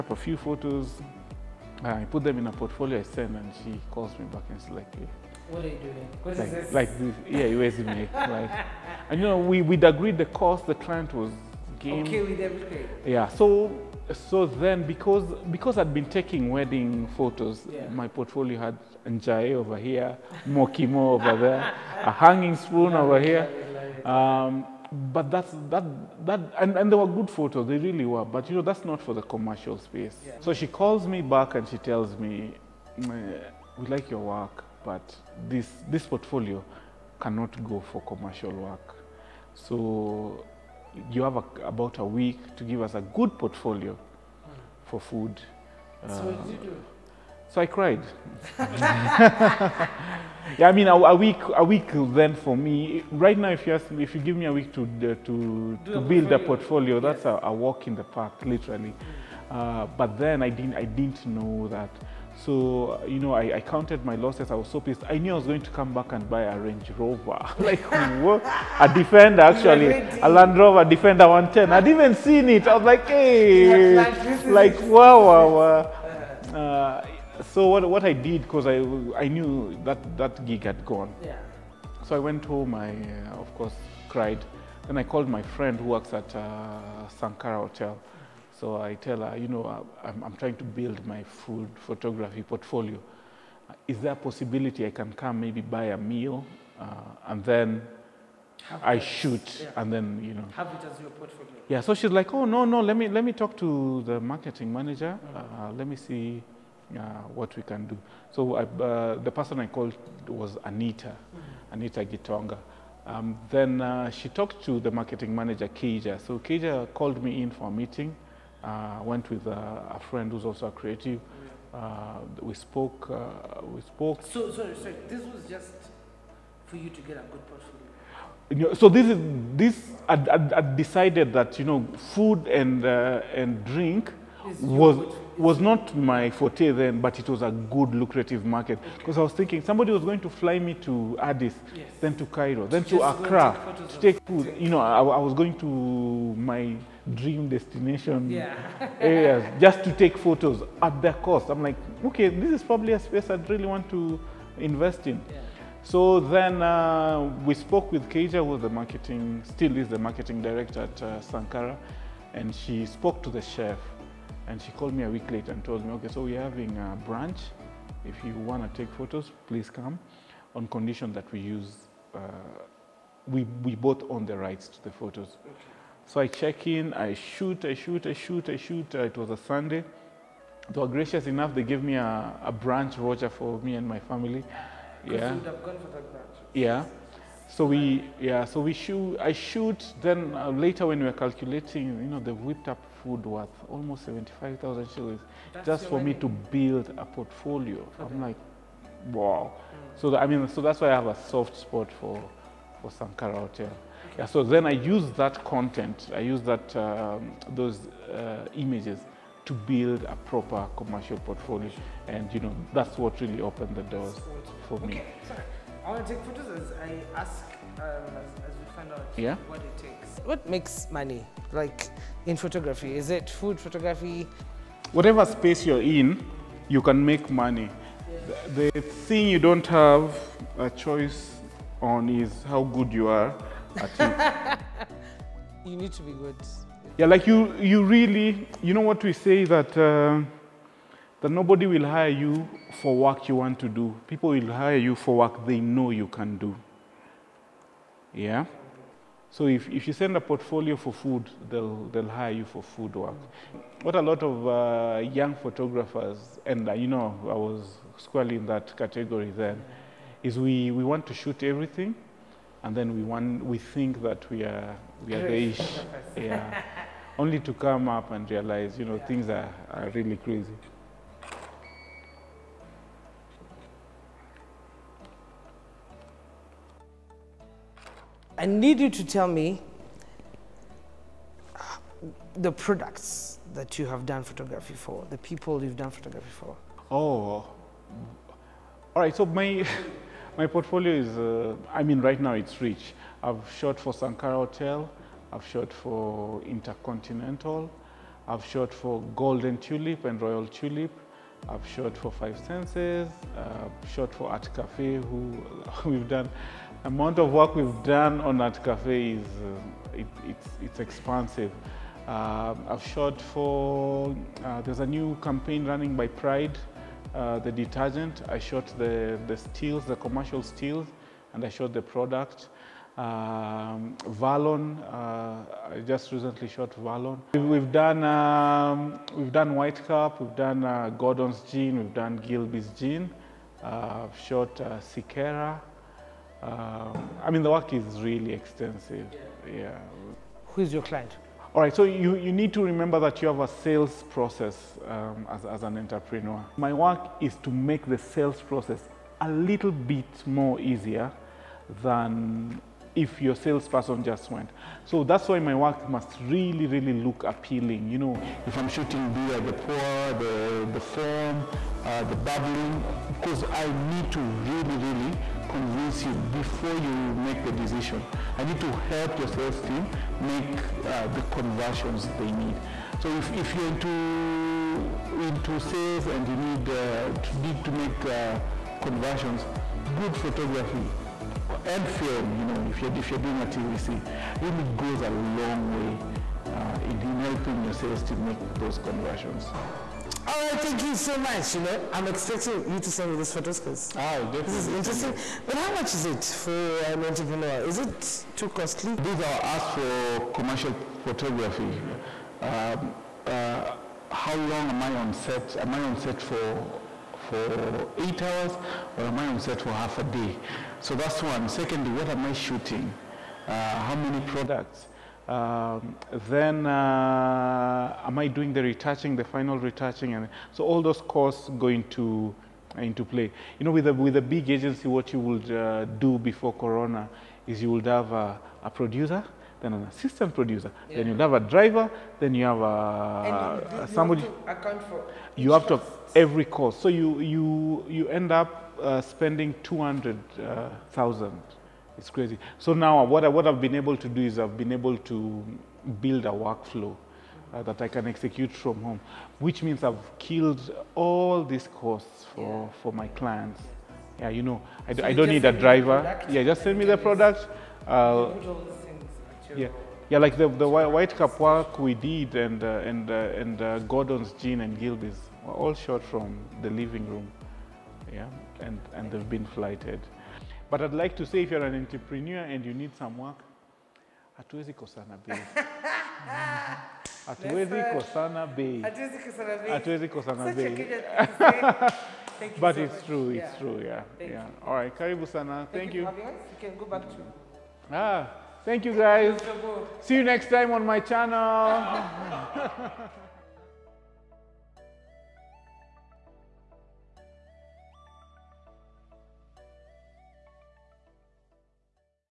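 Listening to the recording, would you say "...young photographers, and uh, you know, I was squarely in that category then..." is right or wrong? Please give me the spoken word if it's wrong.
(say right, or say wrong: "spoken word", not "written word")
right.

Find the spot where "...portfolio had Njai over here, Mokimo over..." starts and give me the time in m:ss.
0:18.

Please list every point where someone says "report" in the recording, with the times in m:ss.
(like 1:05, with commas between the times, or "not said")
not said.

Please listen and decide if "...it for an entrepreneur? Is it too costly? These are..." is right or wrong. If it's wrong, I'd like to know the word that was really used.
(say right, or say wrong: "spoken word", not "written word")
right.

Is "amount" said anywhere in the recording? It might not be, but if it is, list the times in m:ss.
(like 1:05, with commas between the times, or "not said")
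5:06.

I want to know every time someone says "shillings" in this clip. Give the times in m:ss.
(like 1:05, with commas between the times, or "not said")
3:14.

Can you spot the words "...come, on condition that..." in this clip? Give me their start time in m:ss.
2:49.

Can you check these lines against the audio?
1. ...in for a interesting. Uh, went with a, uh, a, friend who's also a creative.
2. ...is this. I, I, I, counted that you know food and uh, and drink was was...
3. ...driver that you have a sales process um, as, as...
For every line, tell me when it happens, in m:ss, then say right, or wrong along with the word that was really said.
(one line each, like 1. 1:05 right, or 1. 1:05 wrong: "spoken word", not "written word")
1. 1:57 wrong: "meeting", not "interesting"
2. 2:09 wrong: "decided", not "counted"
3. 5:42 wrong: "remember", not "driver".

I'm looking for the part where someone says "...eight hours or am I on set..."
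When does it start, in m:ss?
6:47.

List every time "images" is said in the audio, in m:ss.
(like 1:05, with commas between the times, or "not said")
3:28.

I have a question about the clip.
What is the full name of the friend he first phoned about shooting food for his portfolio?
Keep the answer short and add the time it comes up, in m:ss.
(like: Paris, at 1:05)
Anita Gitonga, at 1:51.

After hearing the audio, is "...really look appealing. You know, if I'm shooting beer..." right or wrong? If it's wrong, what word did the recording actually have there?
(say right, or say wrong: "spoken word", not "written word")
right.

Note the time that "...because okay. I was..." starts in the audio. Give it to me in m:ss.
2:18.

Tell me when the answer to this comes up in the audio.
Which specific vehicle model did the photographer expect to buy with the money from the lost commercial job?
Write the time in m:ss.
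1:10.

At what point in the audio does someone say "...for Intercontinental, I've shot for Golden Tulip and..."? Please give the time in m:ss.
4:55.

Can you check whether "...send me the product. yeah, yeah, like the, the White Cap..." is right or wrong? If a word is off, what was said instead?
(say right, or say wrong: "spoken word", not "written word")
right.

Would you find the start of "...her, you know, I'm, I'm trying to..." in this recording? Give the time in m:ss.
1:29.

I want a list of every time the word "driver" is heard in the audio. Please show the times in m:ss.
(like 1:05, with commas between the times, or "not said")
7:11, 7:35.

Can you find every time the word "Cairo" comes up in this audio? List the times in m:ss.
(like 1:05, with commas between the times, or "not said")
2:22.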